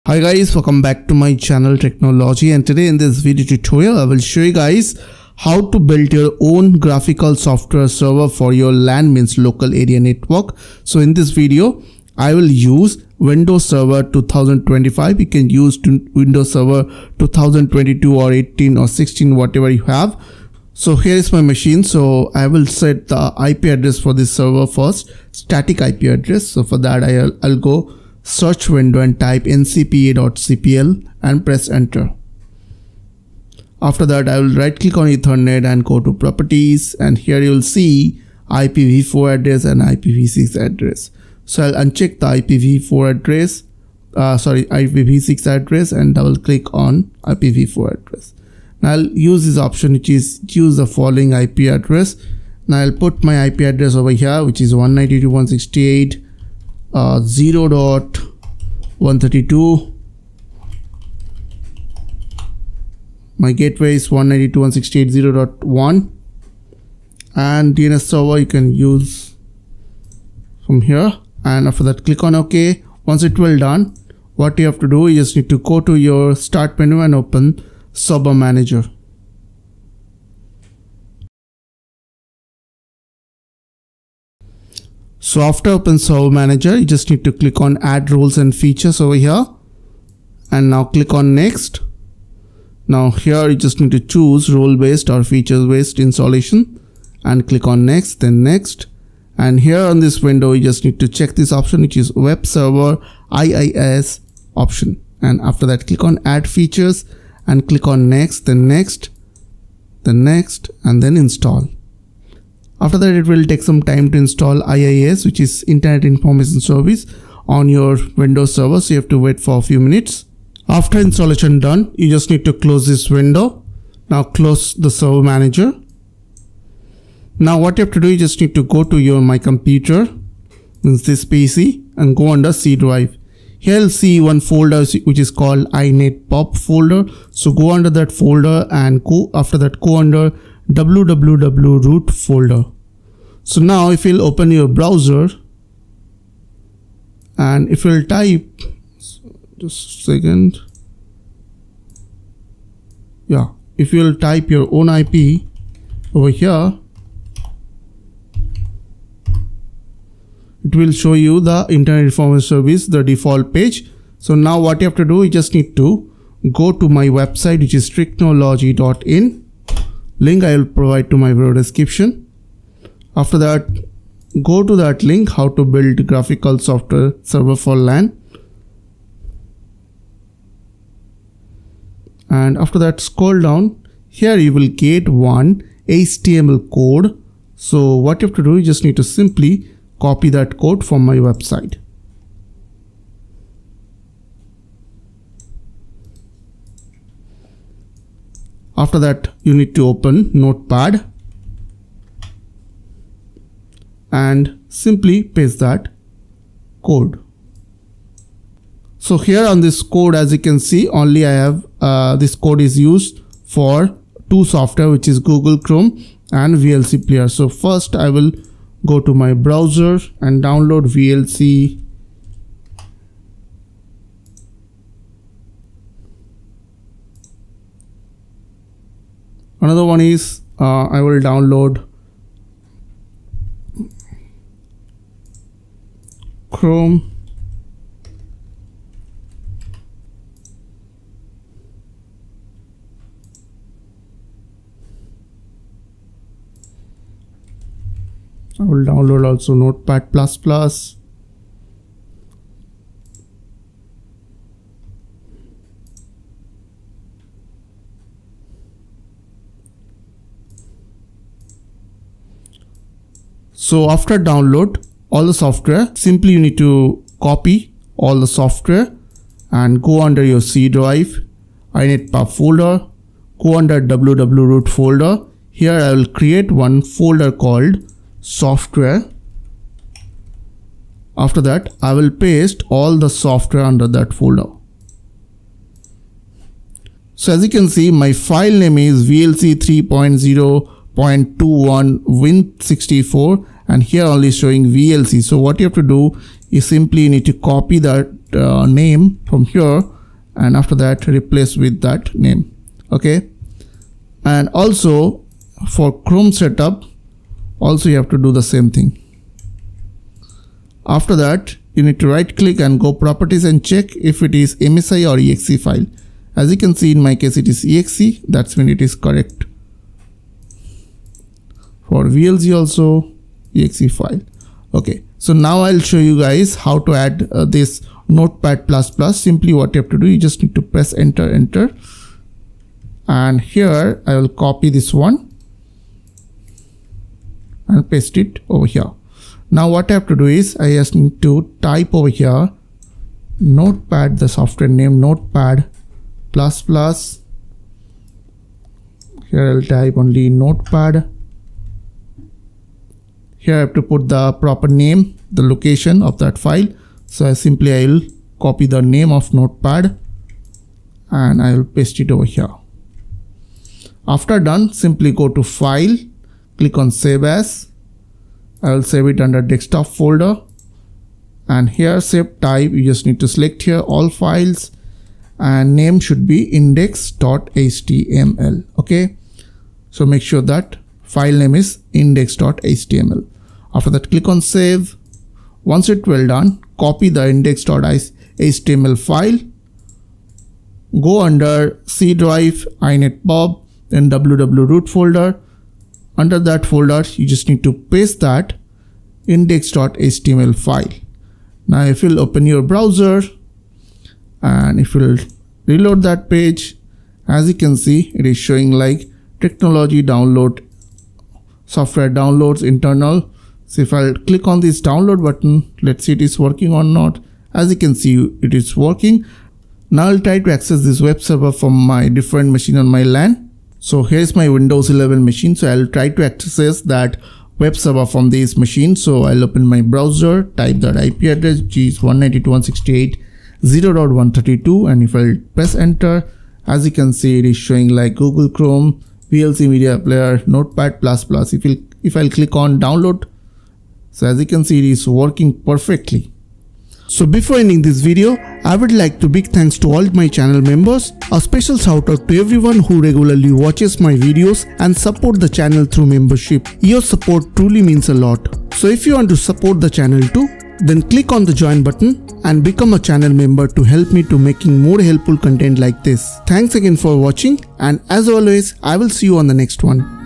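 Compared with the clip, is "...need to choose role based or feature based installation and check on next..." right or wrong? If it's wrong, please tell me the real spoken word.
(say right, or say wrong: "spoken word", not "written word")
wrong: "click", not "check".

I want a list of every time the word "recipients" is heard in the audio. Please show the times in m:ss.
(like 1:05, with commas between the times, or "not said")
not said.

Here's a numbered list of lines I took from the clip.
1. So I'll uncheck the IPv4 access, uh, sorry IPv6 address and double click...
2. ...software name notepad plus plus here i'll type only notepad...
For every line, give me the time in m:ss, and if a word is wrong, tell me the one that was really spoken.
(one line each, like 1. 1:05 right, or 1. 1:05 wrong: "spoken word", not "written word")
1. 0:41 wrong: "address", not "access"
2. 5:44 right.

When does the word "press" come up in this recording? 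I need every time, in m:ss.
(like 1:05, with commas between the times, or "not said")
0:31, 5:30, 7:15.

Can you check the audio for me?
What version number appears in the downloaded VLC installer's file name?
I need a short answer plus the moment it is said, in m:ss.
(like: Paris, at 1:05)
3.0.21, at 4:49.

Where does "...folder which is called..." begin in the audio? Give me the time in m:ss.
2:14.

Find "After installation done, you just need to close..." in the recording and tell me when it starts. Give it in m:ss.
2:00.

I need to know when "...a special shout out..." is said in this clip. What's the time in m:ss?
7:31.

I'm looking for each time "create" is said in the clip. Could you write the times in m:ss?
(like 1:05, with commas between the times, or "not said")
4:36.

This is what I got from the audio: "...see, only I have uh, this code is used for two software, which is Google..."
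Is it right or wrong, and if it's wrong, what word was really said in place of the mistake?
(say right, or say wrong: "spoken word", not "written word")
right.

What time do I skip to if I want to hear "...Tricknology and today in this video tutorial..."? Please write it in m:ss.
0:01.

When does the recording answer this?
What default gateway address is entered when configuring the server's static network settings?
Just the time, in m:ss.
1:04.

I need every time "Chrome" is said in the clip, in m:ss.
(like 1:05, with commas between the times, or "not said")
3:35, 3:56, 5:06, 7:18.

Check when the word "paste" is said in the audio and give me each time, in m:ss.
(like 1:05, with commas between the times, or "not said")
3:25, 4:42, 5:37, 6:01, 6:37.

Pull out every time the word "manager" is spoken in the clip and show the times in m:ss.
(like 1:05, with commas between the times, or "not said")
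1:18, 1:26, 2:05.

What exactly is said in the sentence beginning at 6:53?
So if I click on this download button, let's see it is working or not.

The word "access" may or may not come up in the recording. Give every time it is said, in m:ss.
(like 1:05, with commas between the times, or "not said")
7:00, 7:06.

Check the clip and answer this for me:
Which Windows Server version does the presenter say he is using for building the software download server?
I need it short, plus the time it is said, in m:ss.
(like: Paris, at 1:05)
Windows Server 2025, at 0:13.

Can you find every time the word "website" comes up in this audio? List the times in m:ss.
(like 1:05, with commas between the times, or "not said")
2:47, 3:11.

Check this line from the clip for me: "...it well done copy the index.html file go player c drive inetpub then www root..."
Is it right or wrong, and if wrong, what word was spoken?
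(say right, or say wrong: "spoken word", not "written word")
wrong: "under", not "player".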